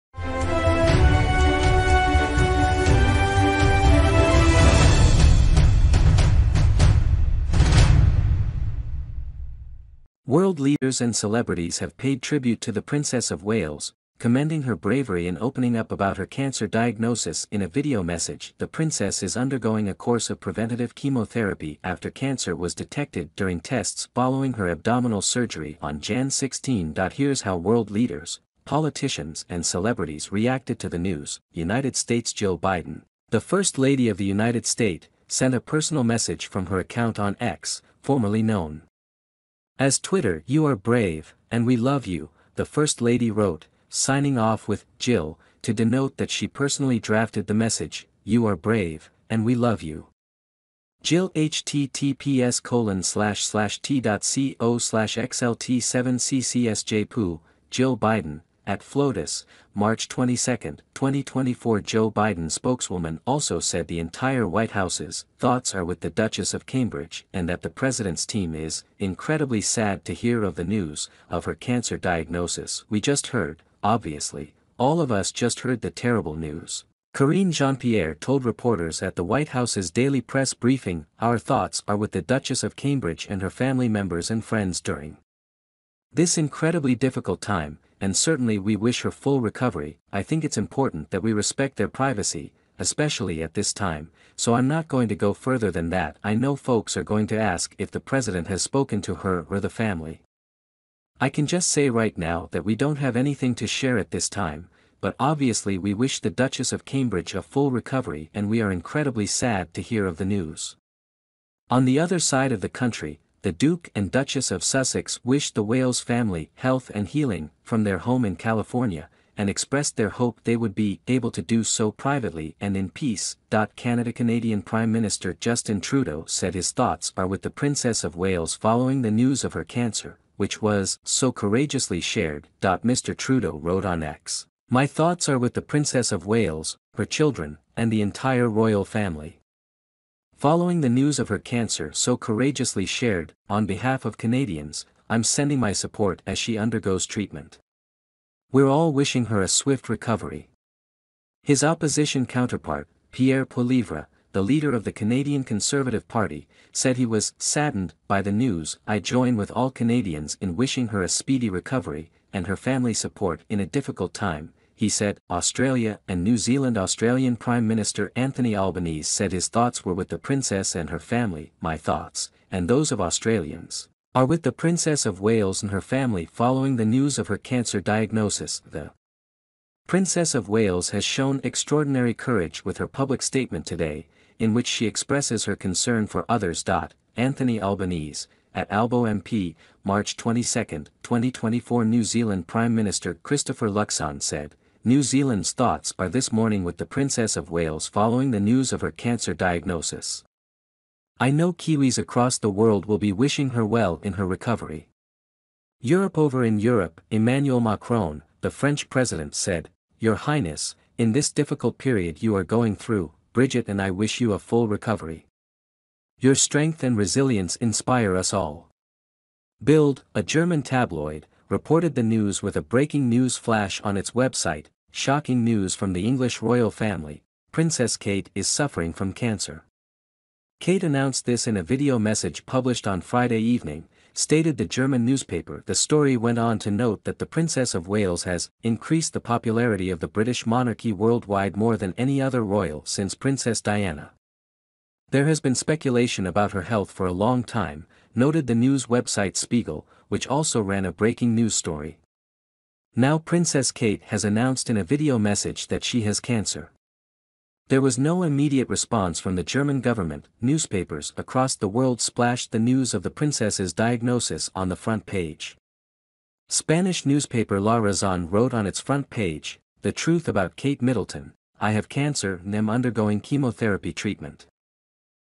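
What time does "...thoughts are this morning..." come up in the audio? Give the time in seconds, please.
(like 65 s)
195 s.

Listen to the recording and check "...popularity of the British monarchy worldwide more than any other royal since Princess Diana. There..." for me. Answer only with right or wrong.
right.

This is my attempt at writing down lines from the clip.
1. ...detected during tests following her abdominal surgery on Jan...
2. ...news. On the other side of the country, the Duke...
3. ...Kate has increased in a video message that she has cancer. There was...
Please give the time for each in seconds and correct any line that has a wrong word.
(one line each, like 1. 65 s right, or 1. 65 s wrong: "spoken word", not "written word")
1. 22 s right
2. 110 s right
3. 253 s wrong: "announced", not "increased".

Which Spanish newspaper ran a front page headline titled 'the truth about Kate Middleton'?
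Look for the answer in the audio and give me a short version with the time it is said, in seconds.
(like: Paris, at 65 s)
La Razón, at 267 s.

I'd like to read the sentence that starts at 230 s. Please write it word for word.
Kate announced this in a video message published on Friday evening, stated the German newspaper.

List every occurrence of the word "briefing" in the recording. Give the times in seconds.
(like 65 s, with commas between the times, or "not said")
80 s.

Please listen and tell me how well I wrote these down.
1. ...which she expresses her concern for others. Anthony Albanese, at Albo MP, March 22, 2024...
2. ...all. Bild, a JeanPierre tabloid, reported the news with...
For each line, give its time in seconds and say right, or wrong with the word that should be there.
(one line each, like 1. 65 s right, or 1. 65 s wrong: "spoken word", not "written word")
1. 184 s right
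2. 218 s wrong: "German", not "JeanPierre".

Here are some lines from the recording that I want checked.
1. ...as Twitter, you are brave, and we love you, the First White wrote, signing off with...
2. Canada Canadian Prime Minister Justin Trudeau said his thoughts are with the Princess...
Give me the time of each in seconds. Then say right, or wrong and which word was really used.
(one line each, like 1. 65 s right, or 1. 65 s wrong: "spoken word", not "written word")
1. 39 s wrong: "Lady", not "White"
2. 123 s right.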